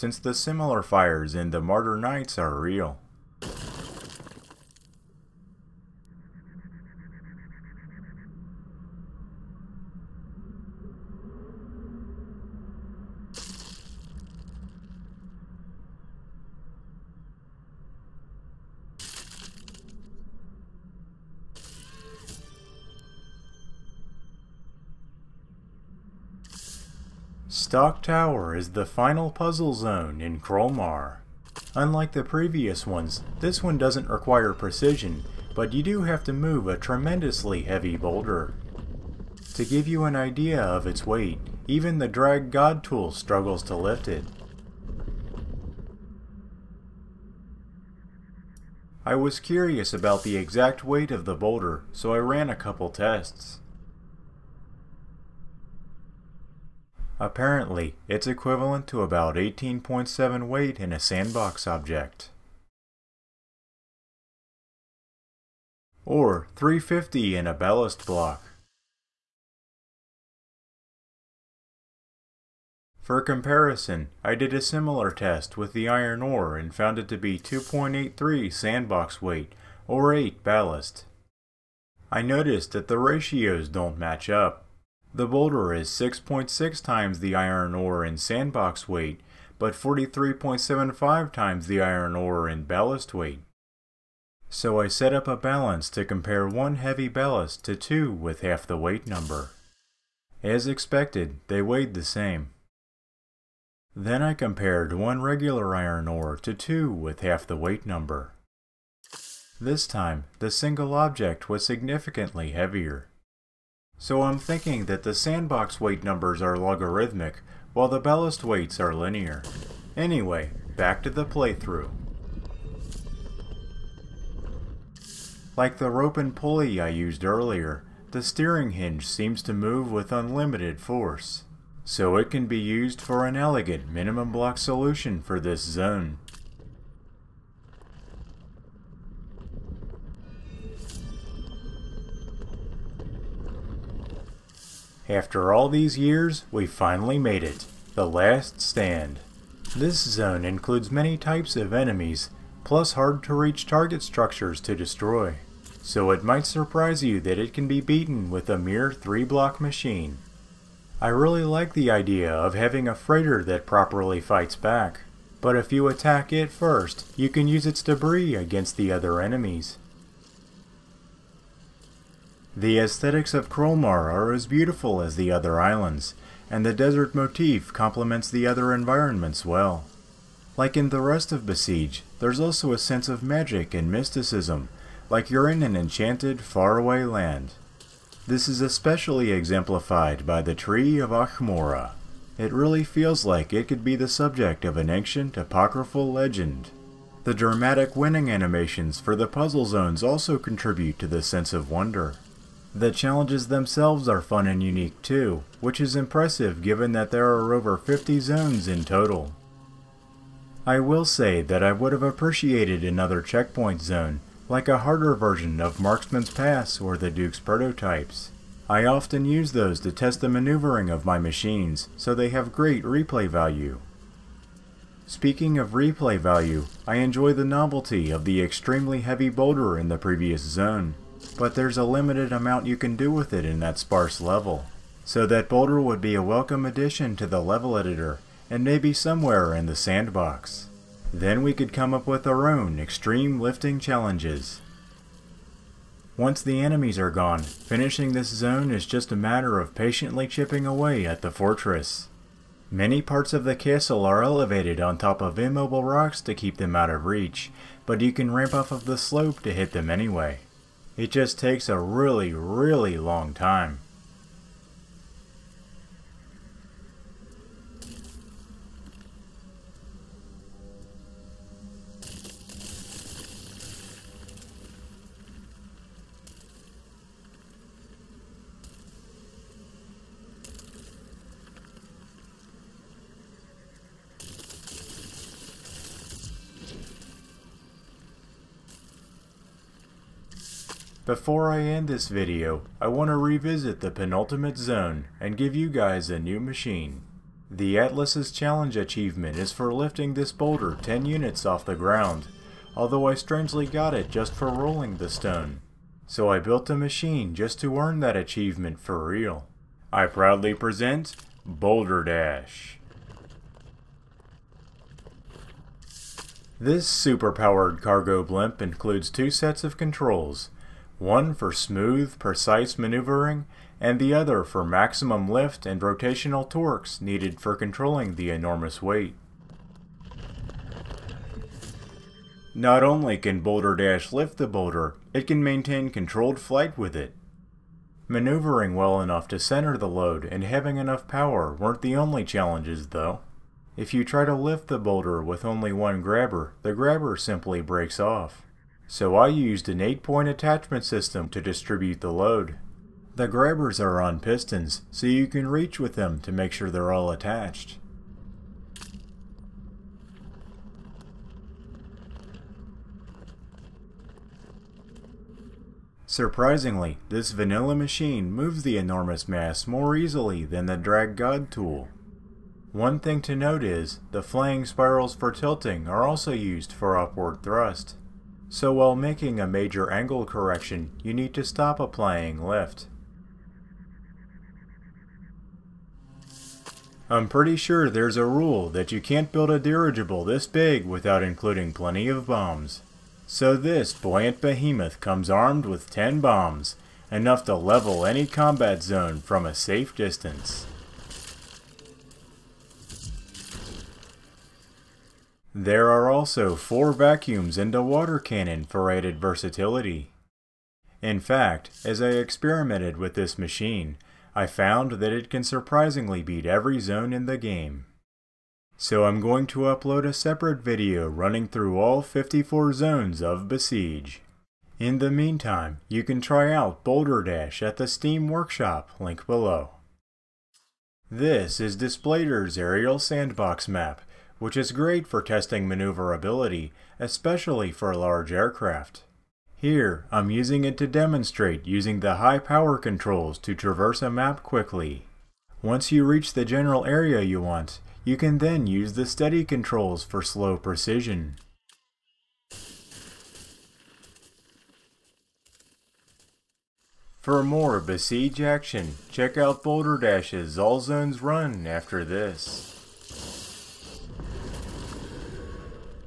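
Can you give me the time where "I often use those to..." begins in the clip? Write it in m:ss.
3:38.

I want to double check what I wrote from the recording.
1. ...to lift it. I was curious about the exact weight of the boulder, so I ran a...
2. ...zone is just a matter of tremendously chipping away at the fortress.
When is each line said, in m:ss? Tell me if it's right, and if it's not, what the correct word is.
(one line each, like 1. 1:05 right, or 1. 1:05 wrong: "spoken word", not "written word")
1. 0:43 right
2. 4:08 wrong: "patiently", not "tremendously".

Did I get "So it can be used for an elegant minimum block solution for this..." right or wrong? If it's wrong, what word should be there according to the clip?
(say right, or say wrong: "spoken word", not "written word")
right.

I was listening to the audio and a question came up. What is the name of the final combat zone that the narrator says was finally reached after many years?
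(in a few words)
The Last Stand.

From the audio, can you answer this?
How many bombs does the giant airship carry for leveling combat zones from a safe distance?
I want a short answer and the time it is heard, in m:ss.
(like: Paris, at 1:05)
10, at 6:35.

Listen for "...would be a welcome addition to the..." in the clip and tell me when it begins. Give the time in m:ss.
3:55.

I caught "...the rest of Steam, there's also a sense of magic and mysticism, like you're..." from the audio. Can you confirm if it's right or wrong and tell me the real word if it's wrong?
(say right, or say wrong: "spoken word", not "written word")
wrong: "Besiege", not "Steam".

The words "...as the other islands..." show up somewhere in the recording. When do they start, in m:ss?
2:55.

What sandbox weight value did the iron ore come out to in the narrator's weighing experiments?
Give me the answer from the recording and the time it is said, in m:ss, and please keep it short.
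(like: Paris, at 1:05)
2.83, at 1:17.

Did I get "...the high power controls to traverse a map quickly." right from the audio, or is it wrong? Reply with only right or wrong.
right.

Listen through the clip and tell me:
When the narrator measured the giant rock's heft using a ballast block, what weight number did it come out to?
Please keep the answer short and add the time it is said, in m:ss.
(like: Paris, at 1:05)
350, at 1:06.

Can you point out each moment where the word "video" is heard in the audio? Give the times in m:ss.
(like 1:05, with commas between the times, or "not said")
4:52, 7:00.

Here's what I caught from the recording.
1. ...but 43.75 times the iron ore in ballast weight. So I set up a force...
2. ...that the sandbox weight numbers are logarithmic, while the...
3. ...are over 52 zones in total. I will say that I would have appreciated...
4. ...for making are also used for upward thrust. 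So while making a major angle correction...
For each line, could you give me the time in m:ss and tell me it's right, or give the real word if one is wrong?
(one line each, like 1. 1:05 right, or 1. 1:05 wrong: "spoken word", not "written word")
1. 1:29 wrong: "balance", not "force"
2. 1:54 right
3. 3:27 wrong: "50", not "52"
4. 6:15 wrong: "tilting", not "making".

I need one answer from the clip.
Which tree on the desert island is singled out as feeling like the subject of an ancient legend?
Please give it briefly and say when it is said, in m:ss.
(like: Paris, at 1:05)
Tree of Achmora, at 3:10.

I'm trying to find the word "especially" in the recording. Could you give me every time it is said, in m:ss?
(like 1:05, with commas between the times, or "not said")
3:08, 7:16.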